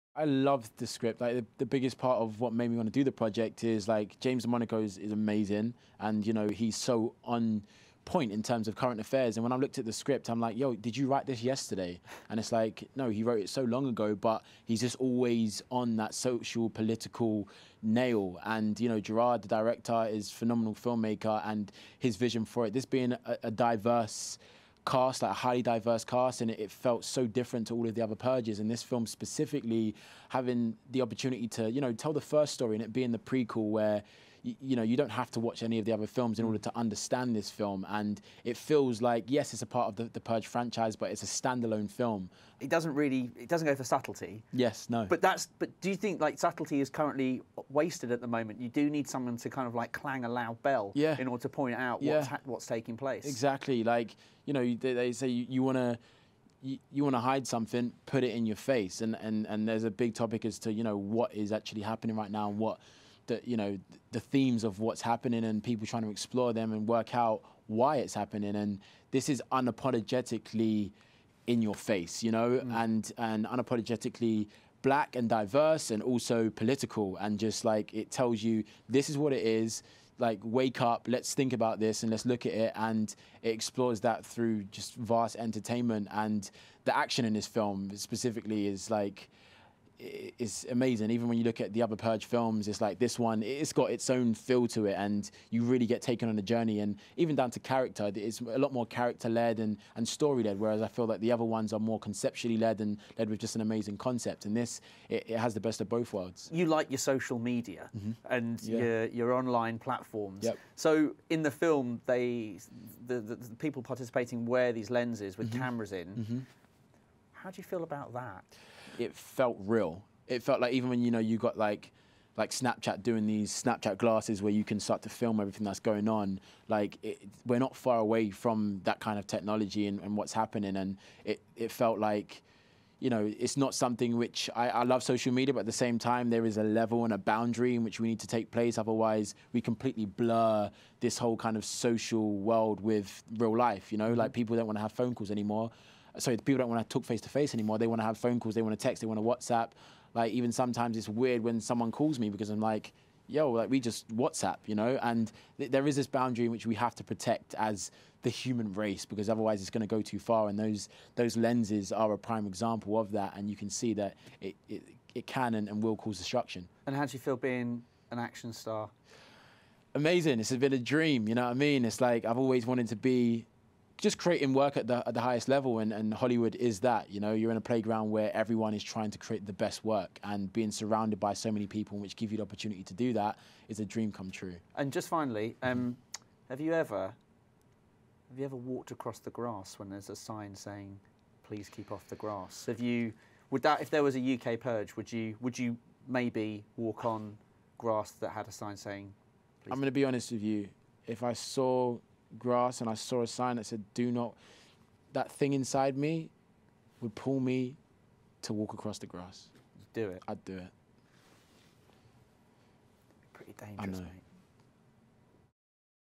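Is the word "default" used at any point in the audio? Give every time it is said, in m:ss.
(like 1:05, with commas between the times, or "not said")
not said.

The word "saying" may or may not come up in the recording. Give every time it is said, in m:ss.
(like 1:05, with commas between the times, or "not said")
3:10, 3:18.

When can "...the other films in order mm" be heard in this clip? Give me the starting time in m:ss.
0:35.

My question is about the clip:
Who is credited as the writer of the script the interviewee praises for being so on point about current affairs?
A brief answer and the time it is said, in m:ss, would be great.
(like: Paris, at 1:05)
James DeMonaco, at 0:04.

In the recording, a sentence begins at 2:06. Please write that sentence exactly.
Like it, we're not far away from that kind of technology and, and, what's happening.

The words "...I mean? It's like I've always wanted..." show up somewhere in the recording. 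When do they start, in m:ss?
2:51.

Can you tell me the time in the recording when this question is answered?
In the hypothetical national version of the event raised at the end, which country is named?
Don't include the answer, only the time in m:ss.
3:14.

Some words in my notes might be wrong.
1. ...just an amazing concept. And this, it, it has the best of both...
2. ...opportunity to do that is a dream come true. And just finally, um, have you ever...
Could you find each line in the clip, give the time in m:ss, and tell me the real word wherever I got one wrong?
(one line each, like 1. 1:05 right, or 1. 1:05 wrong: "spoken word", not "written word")
1. 1:43 right
2. 3:02 right.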